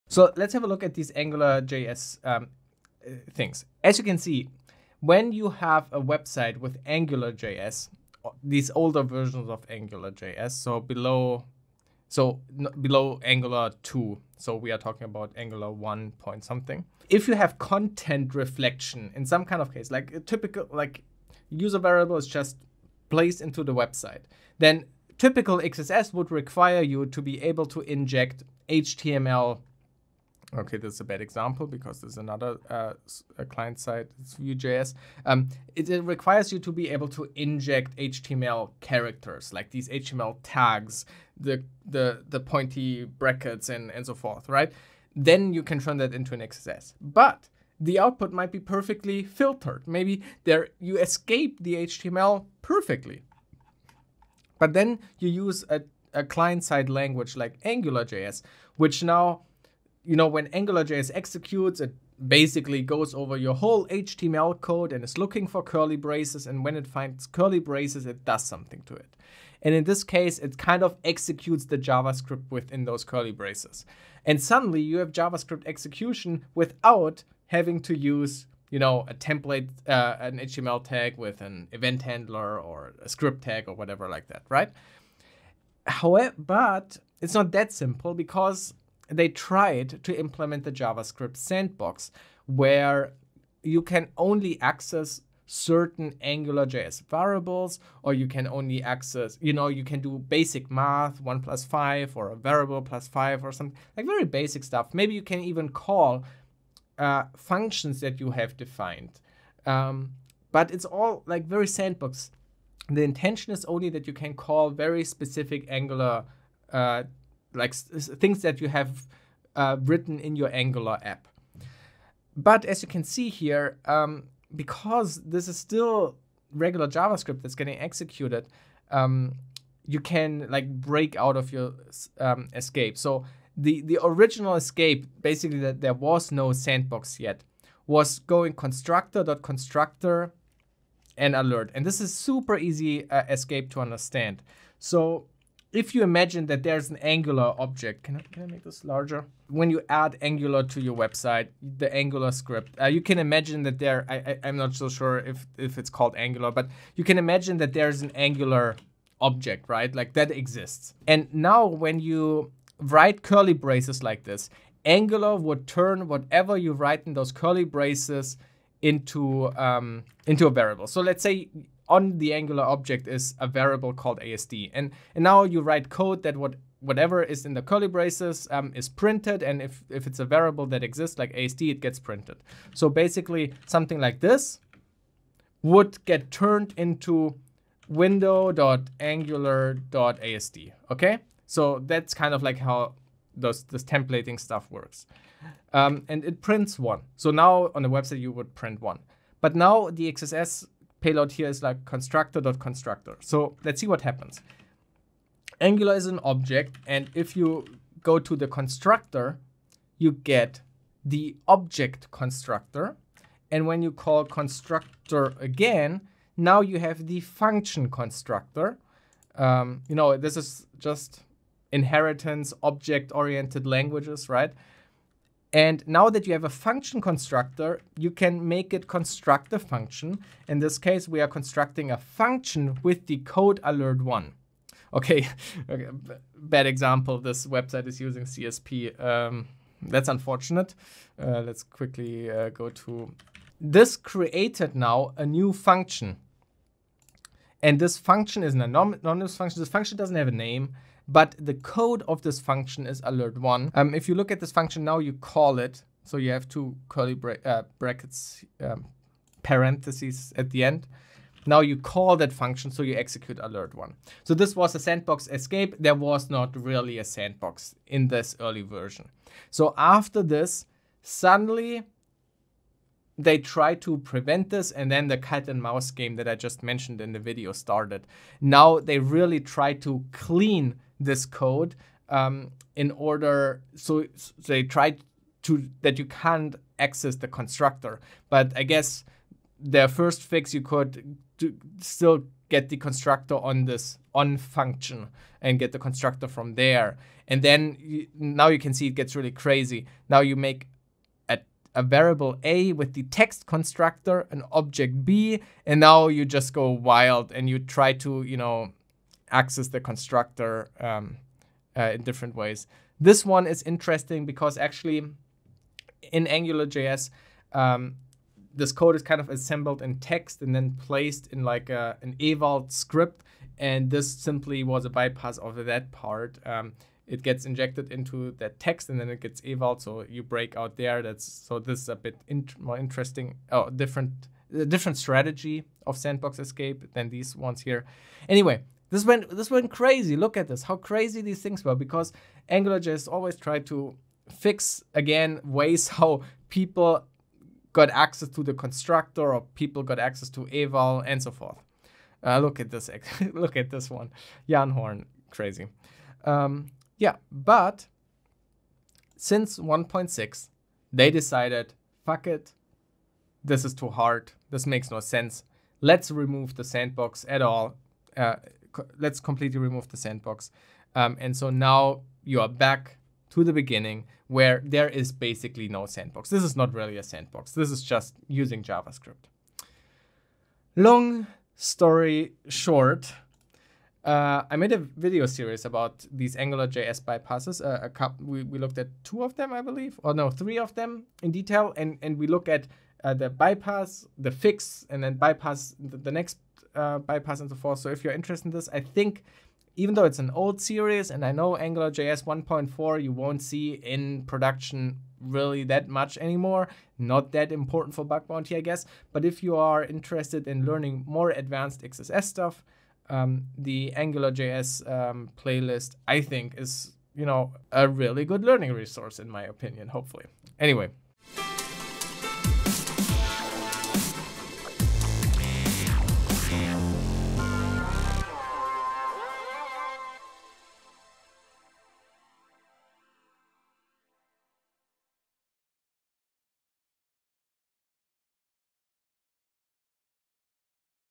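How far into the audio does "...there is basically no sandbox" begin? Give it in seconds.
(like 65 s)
374 s.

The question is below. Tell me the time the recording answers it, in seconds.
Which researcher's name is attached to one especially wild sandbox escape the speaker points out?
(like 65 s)
354 s.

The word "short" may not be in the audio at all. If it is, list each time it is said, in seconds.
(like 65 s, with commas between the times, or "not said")
382 s.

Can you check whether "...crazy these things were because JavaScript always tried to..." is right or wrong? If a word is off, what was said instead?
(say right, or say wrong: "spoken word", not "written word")
wrong: "AngularJS", not "JavaScript".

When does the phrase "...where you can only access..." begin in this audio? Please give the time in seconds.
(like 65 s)
92 s.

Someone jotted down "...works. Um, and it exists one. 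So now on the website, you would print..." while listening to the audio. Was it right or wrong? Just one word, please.
wrong.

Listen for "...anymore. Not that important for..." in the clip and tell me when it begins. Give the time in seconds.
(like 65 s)
406 s.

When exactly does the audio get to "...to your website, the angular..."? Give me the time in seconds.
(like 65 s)
150 s.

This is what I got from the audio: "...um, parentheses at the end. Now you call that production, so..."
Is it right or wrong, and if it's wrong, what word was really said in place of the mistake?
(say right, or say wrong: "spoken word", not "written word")
wrong: "function", not "production".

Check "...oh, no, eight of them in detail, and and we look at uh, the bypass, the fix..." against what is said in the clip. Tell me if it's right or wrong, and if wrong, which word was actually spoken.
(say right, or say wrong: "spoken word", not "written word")
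wrong: "three", not "eight".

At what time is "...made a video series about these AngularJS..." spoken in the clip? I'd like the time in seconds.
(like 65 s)
384 s.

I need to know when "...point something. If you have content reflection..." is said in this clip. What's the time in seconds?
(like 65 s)
16 s.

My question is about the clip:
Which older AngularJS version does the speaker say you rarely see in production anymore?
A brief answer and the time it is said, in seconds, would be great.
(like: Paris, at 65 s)
1.4, at 401 s.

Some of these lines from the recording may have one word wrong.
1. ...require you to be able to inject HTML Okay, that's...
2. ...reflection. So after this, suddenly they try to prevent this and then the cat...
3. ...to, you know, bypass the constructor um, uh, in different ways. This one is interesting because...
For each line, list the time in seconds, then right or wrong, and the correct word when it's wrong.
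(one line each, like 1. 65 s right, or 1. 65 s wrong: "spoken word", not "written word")
1. 26 s right
2. 268 s wrong: "version", not "reflection"
3. 307 s wrong: "access", not "bypass".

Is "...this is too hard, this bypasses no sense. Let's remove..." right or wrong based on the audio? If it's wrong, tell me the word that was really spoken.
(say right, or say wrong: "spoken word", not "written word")
wrong: "makes", not "bypasses".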